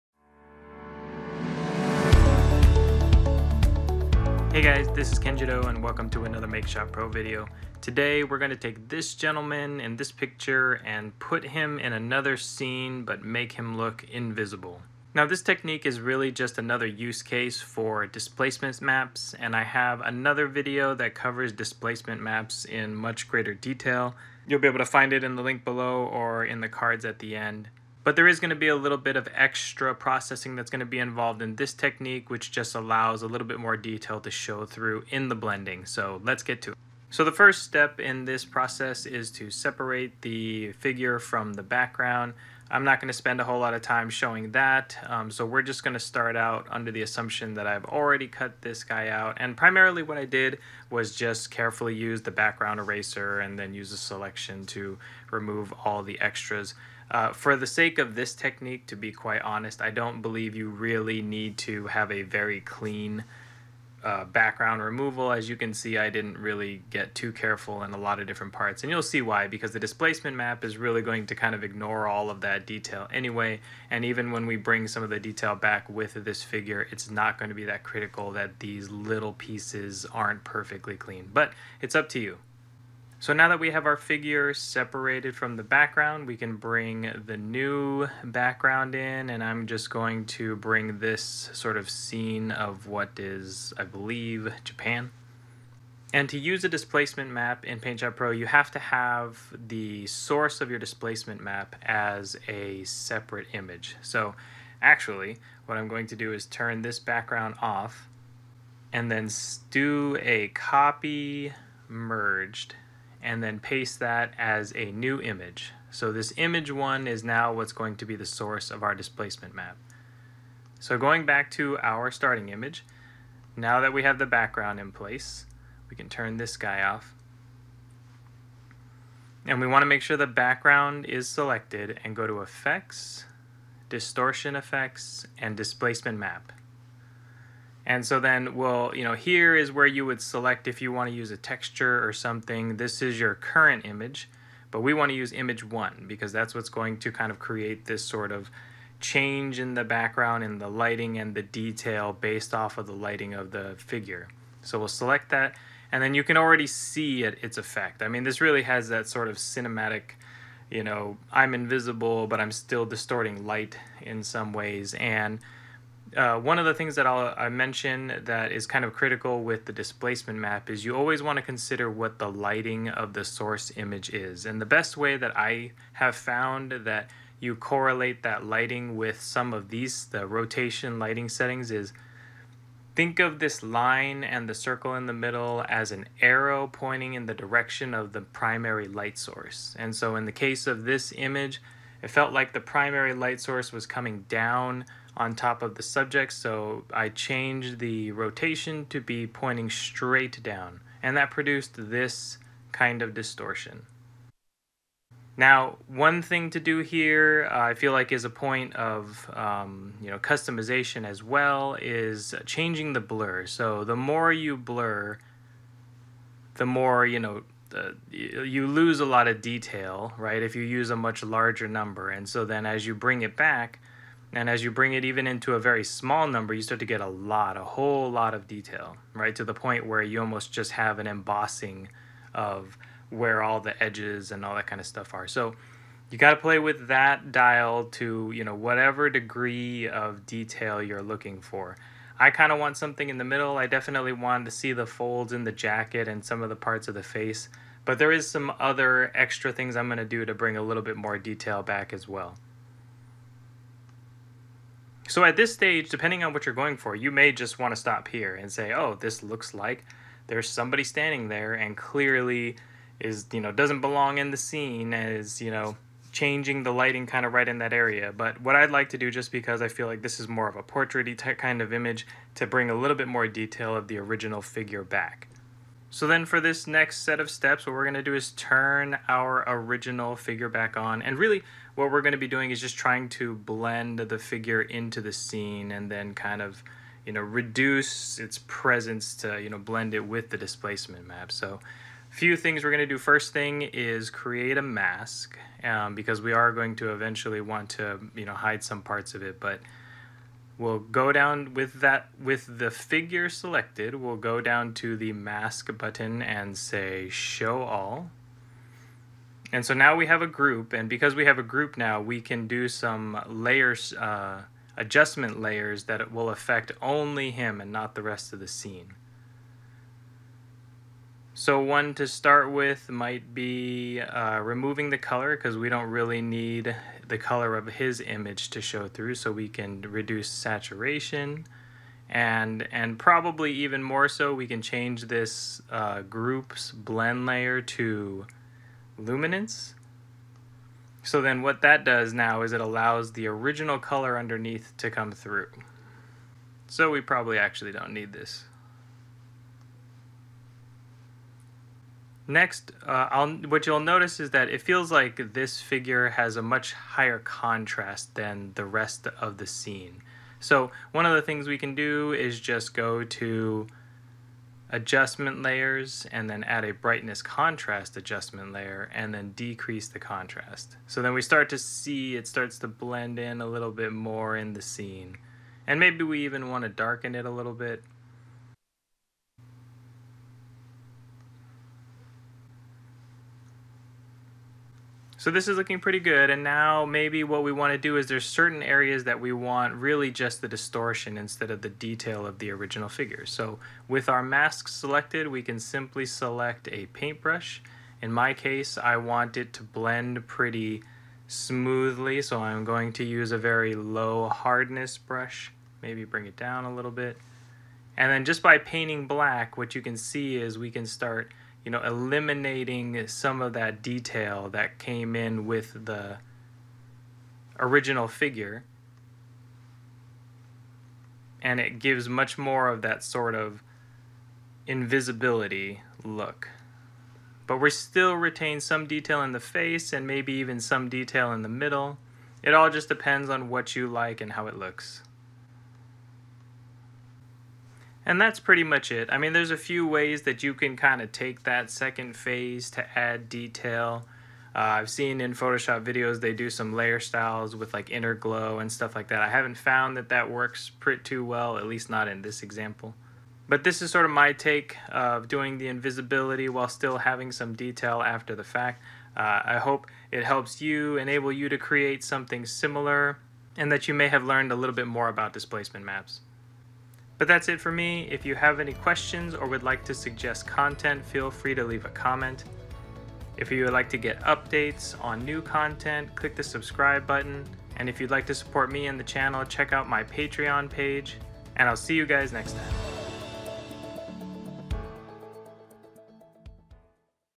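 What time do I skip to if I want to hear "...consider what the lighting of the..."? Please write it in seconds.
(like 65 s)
171 s.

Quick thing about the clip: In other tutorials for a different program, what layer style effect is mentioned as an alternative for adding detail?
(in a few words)
Inner glow.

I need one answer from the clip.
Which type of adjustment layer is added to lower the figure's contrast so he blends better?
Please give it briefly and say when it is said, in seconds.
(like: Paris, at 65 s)
Brightness contrast, at 366 s.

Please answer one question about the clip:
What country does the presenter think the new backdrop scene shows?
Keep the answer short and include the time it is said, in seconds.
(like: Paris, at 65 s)
Japan, at 94 s.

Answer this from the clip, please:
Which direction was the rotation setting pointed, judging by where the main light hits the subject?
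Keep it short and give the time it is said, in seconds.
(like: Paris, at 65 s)
Straight down, at 199 s.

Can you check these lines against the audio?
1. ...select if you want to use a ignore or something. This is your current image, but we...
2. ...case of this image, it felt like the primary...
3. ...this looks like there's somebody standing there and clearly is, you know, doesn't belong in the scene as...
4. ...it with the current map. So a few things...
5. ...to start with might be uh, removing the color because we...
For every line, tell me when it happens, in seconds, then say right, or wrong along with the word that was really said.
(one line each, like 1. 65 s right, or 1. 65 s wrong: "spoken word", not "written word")
1. 140 s wrong: "texture", not "ignore"
2. 190 s right
3. 258 s right
4. 289 s wrong: "displacement", not "current"
5. 321 s right.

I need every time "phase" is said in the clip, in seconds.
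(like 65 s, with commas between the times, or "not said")
442 s.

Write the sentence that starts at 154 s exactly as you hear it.
So we'll select that and then you can already see it, its effect.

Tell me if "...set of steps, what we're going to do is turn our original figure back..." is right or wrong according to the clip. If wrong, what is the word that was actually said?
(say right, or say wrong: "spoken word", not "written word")
right.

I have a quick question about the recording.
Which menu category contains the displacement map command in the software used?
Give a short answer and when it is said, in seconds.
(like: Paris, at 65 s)
Distortion Effects, at 133 s.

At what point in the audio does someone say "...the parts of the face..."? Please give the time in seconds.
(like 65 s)
246 s.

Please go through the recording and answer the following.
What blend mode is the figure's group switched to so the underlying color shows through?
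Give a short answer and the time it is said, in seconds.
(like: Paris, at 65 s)
Luminance, at 338 s.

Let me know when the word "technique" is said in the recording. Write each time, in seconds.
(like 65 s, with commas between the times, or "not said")
15 s, 31 s, 58 s.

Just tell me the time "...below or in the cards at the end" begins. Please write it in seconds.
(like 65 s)
25 s.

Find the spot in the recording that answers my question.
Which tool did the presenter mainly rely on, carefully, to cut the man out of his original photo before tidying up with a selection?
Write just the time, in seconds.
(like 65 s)
52 s.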